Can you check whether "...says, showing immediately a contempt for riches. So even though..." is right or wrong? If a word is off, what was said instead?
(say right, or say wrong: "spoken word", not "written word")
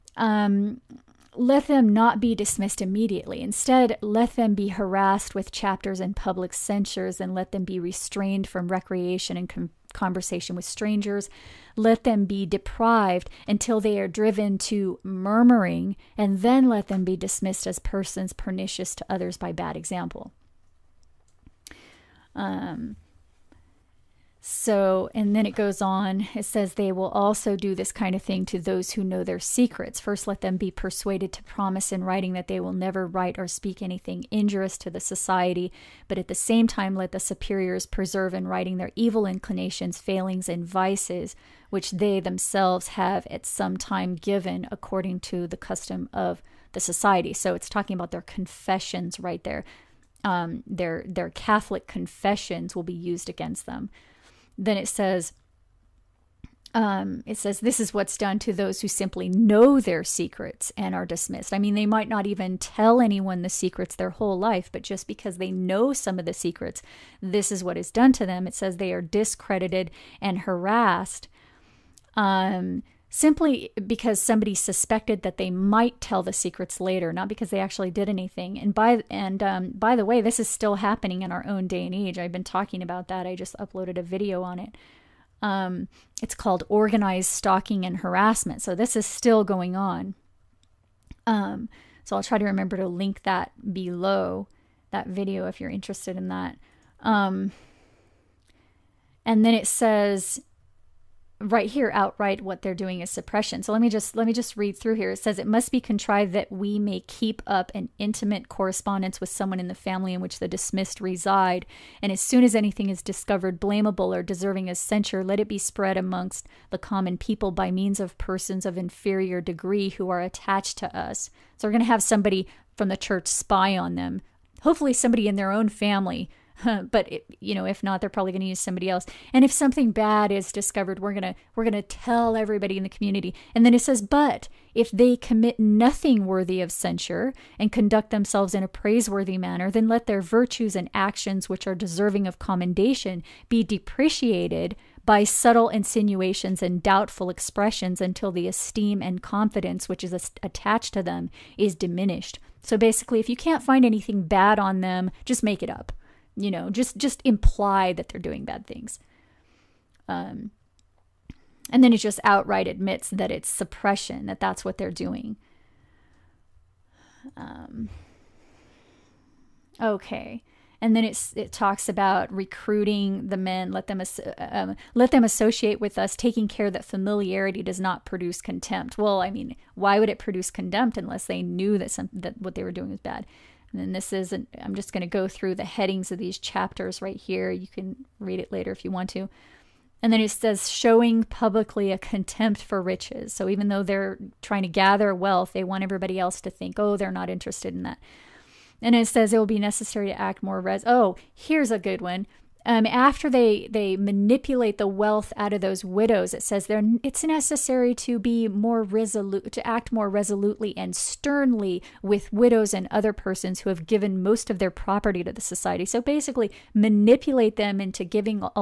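wrong: "publicly", not "immediately".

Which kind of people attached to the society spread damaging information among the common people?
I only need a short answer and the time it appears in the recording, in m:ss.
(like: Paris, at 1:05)
persons of inferior degree, at 1:58.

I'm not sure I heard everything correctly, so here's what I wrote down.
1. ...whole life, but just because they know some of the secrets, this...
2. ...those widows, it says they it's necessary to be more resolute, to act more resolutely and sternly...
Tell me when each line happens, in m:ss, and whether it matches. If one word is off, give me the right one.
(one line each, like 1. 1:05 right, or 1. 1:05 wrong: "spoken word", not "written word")
1. 1:04 right
2. 3:25 right.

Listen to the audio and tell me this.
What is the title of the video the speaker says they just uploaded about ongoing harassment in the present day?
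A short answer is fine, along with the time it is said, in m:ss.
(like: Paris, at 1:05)
organized stalking and harassment, at 1:26.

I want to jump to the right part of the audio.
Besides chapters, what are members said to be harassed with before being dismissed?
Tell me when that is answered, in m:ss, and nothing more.
0:06.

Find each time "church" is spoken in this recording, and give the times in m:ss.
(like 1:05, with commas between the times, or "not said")
2:02.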